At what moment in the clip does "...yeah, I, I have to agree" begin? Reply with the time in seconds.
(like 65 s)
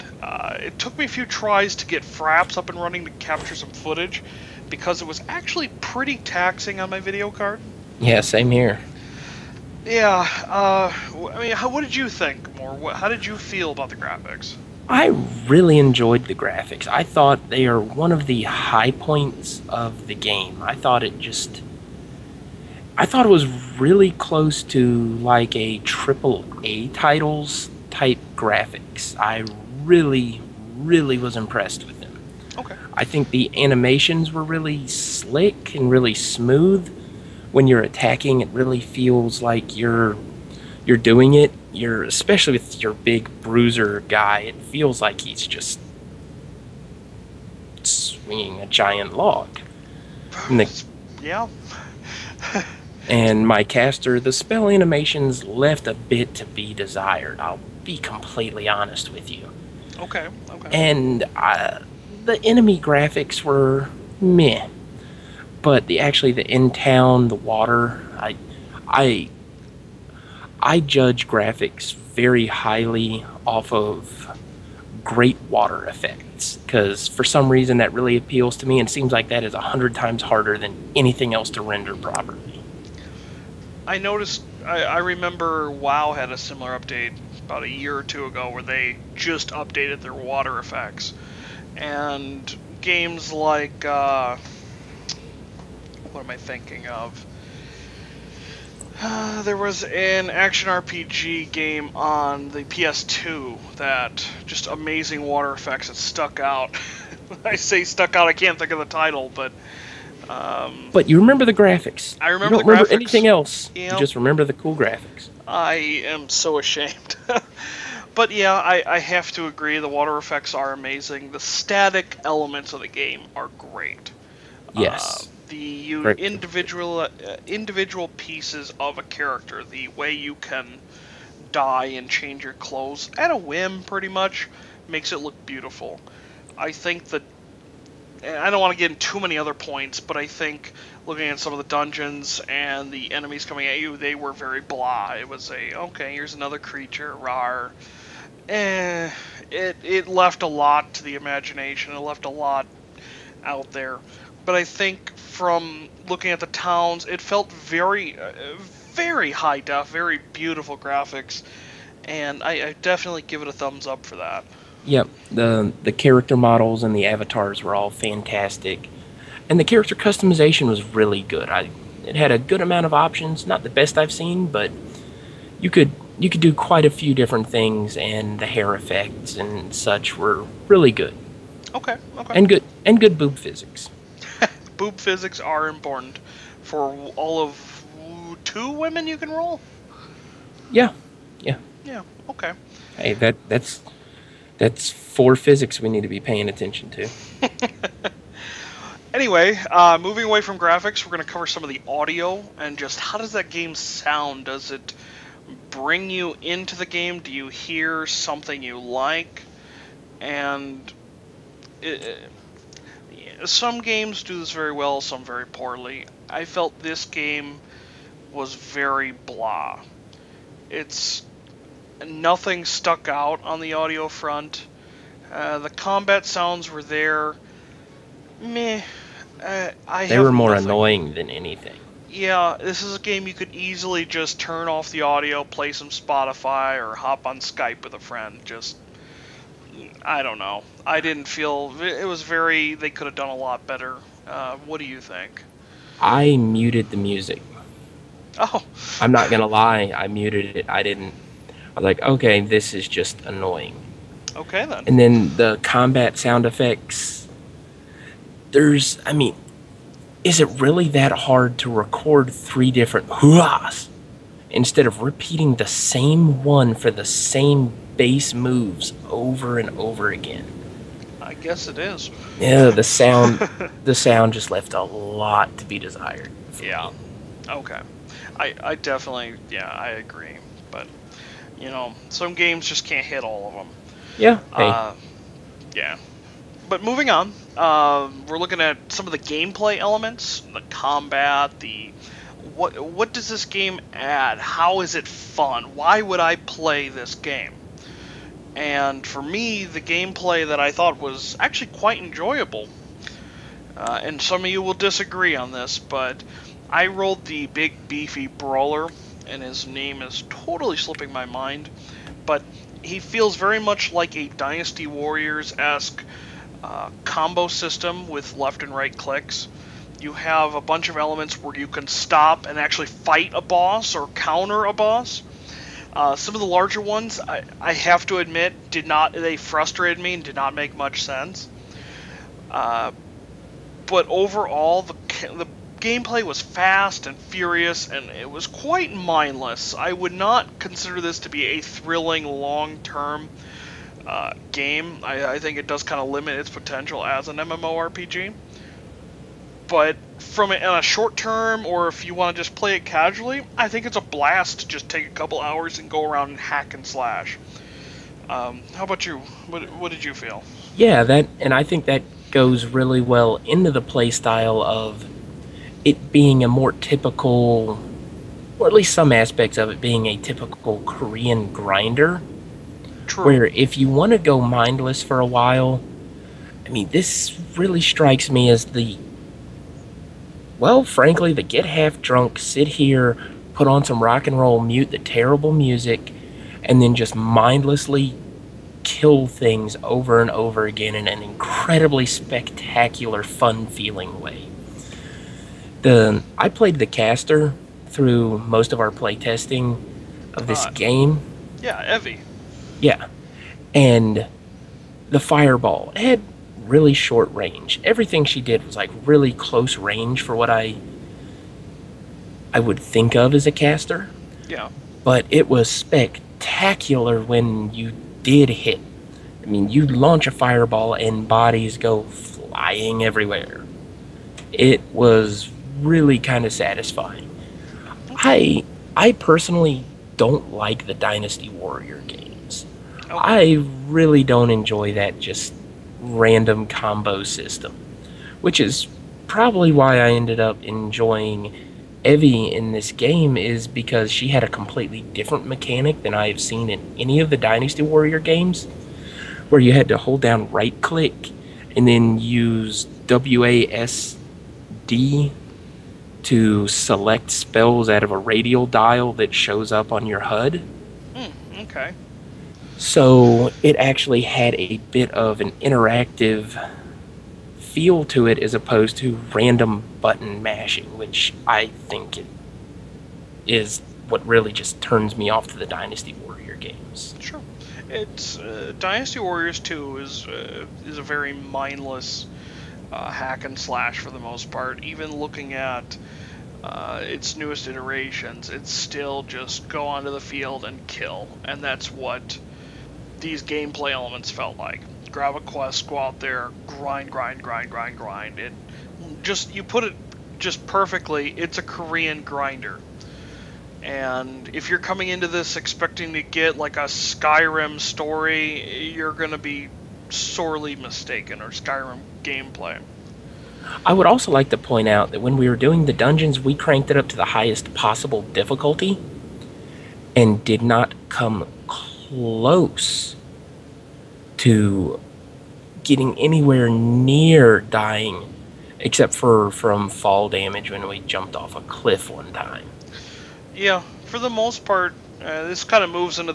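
118 s.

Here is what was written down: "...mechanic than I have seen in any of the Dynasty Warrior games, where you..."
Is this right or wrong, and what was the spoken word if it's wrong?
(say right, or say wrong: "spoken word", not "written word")
right.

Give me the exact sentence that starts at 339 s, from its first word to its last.
I would not consider this to be a thrilling long term.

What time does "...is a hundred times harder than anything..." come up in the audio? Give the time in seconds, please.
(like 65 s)
79 s.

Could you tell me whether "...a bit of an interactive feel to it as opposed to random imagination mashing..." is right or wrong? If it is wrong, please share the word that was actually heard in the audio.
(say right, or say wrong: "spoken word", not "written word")
wrong: "button", not "imagination".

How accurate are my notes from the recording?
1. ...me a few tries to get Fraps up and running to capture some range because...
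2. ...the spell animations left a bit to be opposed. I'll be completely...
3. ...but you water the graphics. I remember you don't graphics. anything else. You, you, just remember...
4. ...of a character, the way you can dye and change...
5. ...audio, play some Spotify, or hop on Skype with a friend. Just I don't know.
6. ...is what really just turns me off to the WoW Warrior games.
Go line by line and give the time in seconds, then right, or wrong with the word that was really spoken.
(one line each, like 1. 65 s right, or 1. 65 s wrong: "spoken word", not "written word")
1. 0 s wrong: "footage", not "range"
2. 54 s wrong: "desired", not "opposed"
3. 110 s wrong: "remember", not "water"
4. 128 s right
5. 235 s right
6. 473 s wrong: "Dynasty", not "WoW".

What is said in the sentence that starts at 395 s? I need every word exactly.
The I played the caster through most of our playtesting of this uh, game.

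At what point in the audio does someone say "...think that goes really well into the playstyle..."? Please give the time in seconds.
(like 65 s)
361 s.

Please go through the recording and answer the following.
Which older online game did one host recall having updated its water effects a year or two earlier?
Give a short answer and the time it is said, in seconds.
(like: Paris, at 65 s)
WoW, at 85 s.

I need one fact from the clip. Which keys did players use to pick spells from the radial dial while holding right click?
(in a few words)
WASD.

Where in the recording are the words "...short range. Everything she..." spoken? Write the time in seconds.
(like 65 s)
406 s.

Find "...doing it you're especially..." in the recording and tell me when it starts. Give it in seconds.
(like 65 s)
40 s.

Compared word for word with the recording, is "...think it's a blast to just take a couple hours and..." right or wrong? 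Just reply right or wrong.
right.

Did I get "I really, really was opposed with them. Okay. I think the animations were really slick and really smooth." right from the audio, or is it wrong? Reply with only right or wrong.
wrong.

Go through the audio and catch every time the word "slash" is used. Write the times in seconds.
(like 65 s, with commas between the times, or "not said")
356 s, 483 s.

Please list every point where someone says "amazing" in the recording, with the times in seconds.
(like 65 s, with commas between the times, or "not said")
104 s, 120 s.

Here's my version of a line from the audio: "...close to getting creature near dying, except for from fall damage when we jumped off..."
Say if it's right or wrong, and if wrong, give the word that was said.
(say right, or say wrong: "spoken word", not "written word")
wrong: "anywhere", not "creature".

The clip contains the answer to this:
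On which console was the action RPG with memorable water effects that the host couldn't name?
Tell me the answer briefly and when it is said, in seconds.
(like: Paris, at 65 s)
PS2, at 102 s.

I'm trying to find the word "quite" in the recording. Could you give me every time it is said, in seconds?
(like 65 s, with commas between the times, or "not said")
176 s, 301 s, 338 s.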